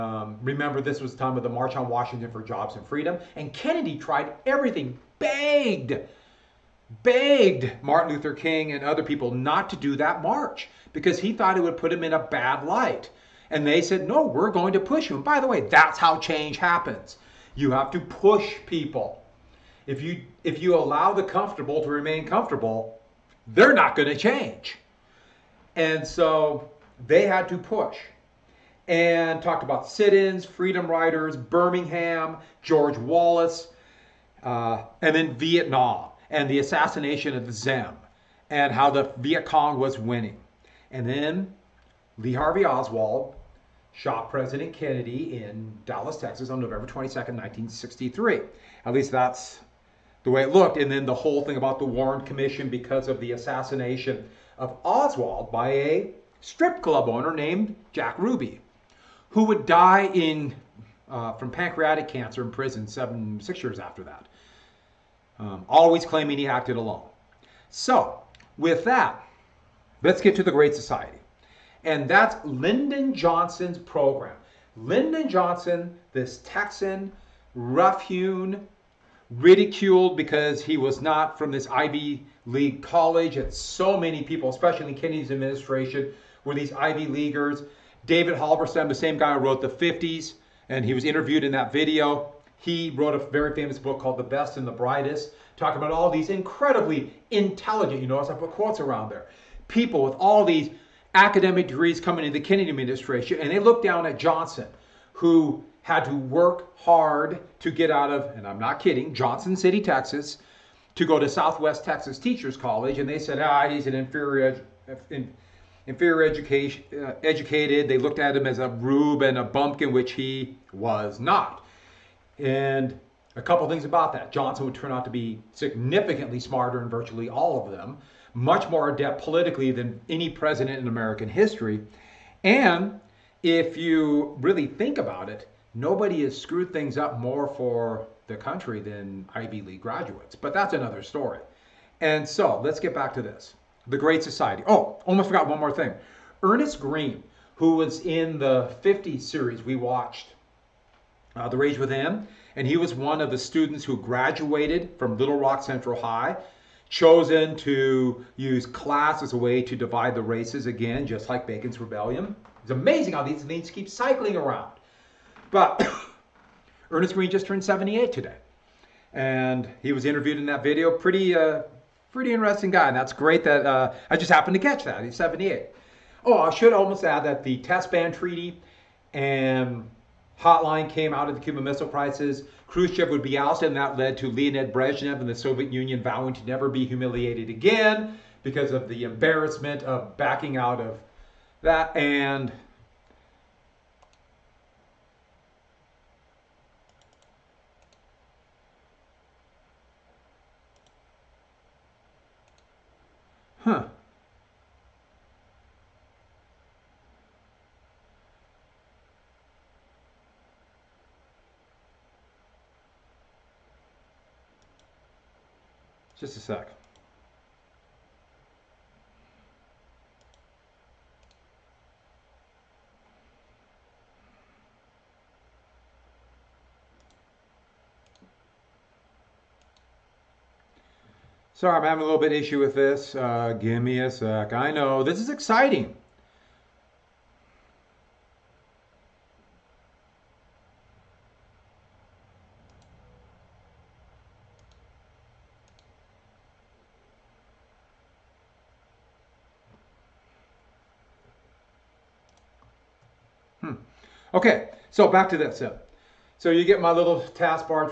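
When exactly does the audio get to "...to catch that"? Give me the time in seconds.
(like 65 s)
174 s.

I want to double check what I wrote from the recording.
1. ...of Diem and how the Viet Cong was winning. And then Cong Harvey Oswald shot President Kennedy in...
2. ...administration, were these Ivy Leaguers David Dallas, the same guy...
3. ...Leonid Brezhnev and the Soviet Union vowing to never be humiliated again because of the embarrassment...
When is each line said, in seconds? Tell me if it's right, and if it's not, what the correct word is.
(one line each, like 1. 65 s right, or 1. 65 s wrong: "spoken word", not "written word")
1. 37 s wrong: "Lee", not "Cong"
2. 85 s wrong: "Halberstam", not "Dallas"
3. 184 s right.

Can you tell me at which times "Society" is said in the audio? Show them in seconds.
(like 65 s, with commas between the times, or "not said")
70 s, 144 s.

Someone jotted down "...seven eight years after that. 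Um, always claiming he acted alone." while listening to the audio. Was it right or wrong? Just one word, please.
wrong.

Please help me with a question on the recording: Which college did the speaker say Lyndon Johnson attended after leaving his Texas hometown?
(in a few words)
Southwest Texas Teachers College.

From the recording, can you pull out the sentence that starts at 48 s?
At least that's the way it looked.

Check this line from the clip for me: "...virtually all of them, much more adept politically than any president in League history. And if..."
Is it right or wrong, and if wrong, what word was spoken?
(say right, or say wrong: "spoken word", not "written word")
wrong: "American", not "League".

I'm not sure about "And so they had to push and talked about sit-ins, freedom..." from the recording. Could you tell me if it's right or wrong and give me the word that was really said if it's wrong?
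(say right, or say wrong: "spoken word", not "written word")
right.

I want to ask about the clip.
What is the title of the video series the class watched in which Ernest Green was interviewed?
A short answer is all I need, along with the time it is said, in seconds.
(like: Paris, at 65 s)
The Rage Within, at 151 s.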